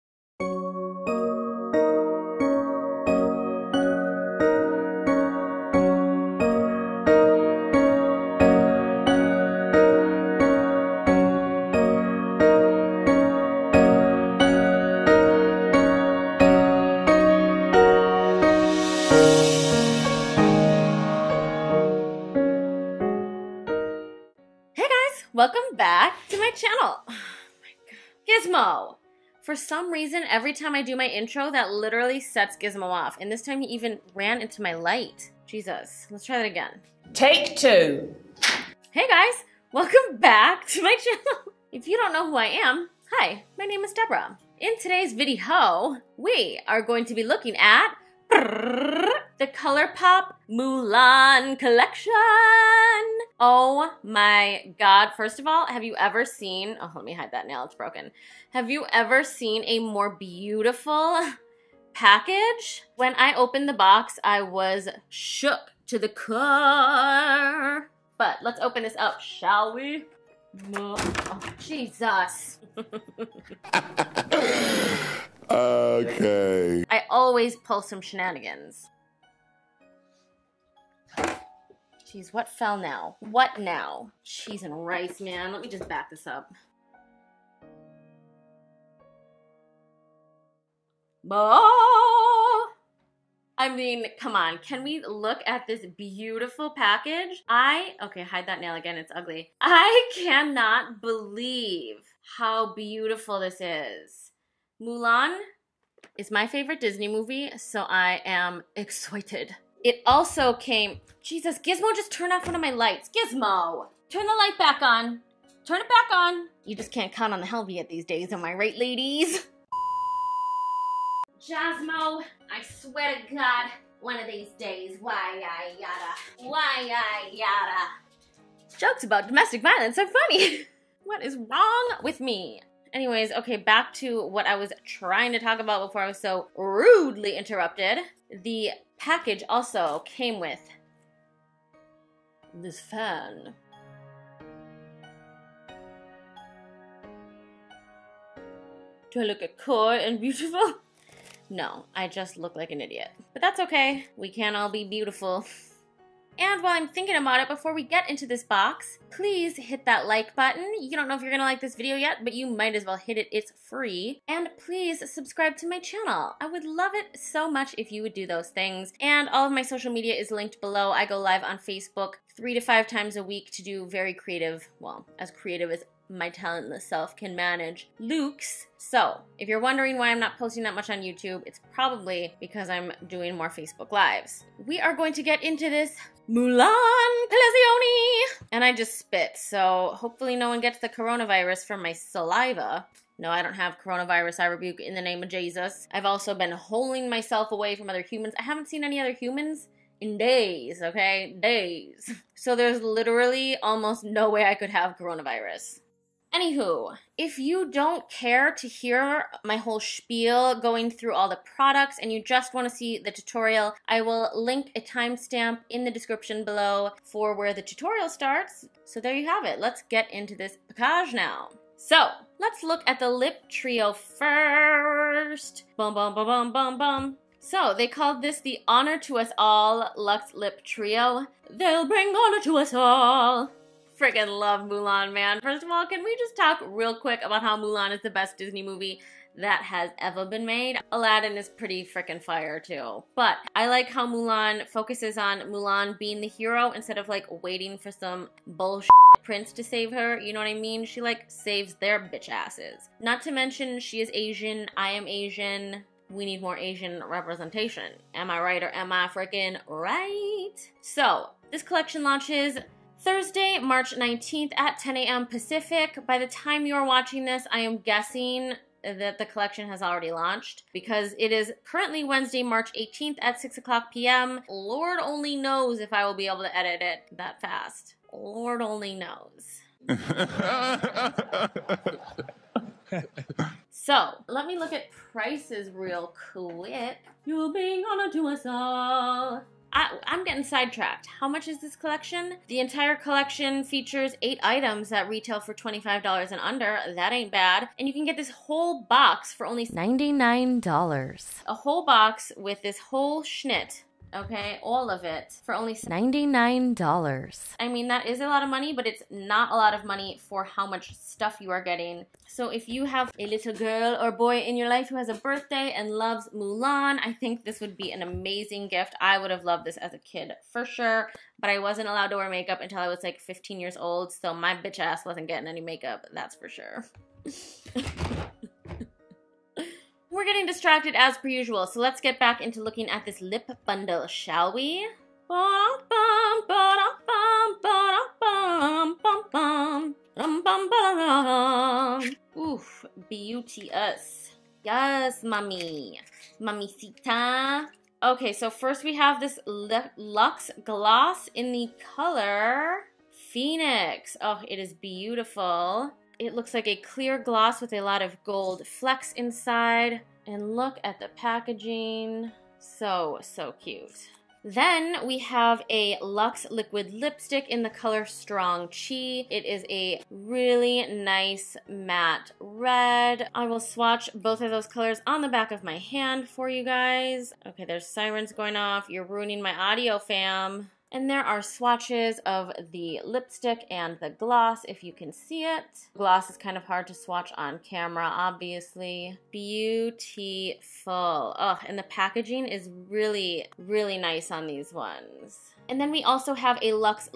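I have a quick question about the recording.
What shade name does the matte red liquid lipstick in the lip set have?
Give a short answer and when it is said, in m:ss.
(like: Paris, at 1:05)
Strong Chi, at 6:08.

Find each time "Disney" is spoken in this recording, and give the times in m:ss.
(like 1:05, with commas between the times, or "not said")
1:46, 3:58.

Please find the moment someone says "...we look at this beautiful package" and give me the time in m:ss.
1:34.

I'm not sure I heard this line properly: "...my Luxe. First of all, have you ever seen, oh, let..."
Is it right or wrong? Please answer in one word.
wrong.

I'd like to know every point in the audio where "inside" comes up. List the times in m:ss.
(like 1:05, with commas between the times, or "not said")
5:59.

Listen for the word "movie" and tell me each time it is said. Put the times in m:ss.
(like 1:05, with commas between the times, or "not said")
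1:47, 3:58.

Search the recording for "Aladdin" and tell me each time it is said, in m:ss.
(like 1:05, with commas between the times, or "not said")
4:00.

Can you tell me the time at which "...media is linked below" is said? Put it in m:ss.
2:49.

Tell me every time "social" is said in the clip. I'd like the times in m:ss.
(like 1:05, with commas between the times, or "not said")
2:49.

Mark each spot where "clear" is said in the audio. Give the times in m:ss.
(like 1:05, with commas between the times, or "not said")
5:56.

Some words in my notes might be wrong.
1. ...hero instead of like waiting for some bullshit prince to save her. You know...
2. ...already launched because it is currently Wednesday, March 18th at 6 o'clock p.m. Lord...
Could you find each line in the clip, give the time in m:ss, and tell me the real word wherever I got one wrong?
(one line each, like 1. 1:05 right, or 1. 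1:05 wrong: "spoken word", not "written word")
1. 4:06 right
2. 4:29 right.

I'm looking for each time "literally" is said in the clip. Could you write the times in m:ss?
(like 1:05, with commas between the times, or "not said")
0:31, 3:22.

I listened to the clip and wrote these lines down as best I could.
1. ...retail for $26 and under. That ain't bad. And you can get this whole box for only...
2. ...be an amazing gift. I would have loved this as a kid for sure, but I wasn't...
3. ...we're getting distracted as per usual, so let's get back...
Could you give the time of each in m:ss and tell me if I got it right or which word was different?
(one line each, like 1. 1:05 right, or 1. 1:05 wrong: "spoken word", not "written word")
1. 4:55 wrong: "25", not "26"
2. 5:17 right
3. 5:30 right.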